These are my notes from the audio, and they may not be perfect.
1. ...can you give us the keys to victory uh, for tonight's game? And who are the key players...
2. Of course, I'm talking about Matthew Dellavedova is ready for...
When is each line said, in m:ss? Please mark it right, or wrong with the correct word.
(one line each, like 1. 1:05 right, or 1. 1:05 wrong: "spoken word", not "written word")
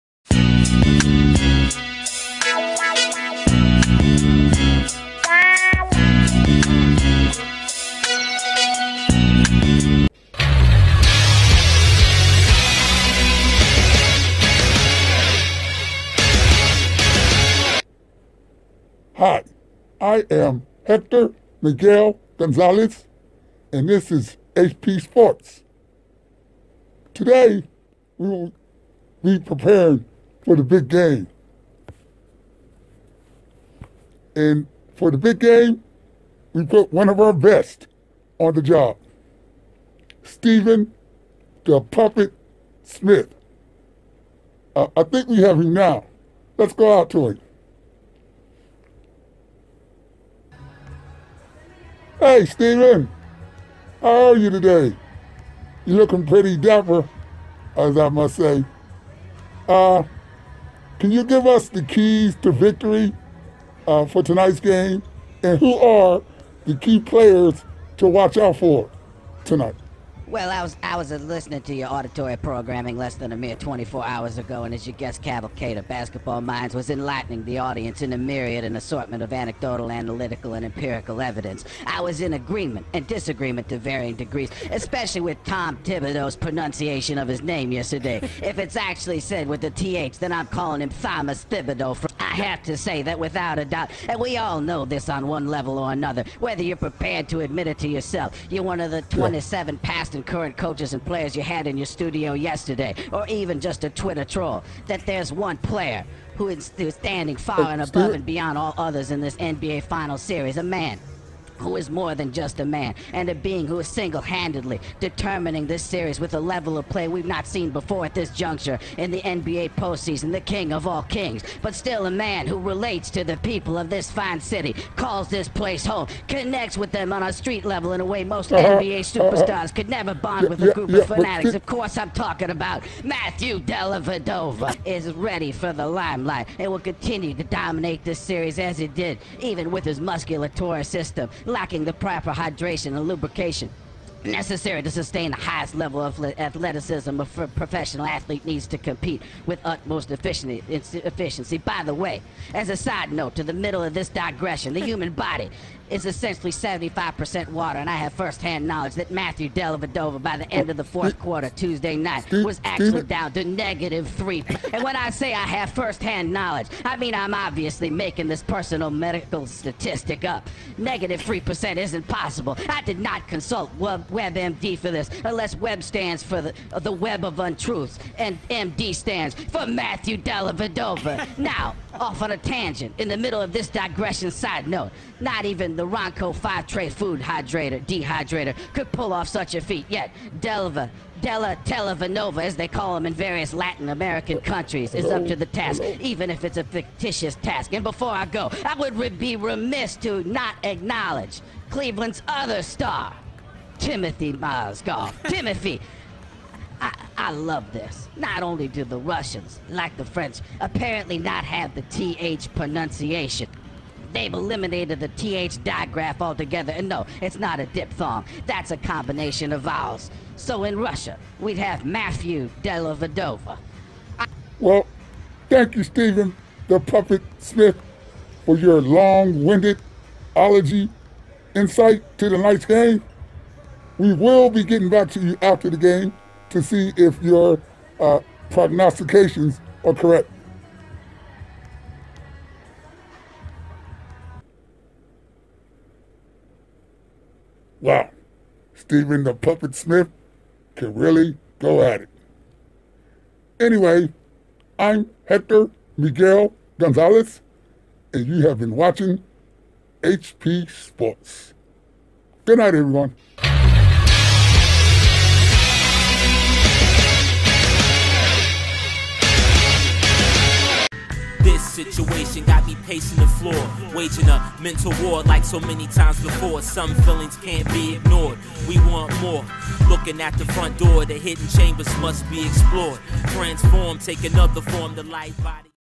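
1. 1:00 right
2. 2:11 right.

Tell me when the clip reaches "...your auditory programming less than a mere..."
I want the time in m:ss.
1:11.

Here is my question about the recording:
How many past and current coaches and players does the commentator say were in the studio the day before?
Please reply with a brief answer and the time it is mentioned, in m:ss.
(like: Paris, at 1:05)
27, at 1:39.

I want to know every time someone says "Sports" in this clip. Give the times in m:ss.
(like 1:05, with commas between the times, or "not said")
0:25, 4:20.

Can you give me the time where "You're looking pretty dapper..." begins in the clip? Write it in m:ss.
0:55.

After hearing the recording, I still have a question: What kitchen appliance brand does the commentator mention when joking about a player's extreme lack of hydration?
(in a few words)
Ronco.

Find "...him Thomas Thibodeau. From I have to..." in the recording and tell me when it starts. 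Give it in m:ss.
1:30.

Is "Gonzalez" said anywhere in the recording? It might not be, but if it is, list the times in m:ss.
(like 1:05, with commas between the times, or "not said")
0:22, 4:16.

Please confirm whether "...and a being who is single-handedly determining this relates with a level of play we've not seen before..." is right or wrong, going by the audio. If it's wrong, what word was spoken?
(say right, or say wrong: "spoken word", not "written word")
wrong: "series", not "relates".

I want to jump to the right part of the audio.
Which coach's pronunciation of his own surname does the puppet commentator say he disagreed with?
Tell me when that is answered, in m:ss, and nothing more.
1:25.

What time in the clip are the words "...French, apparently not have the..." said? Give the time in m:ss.
3:30.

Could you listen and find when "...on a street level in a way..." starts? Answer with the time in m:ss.
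2:07.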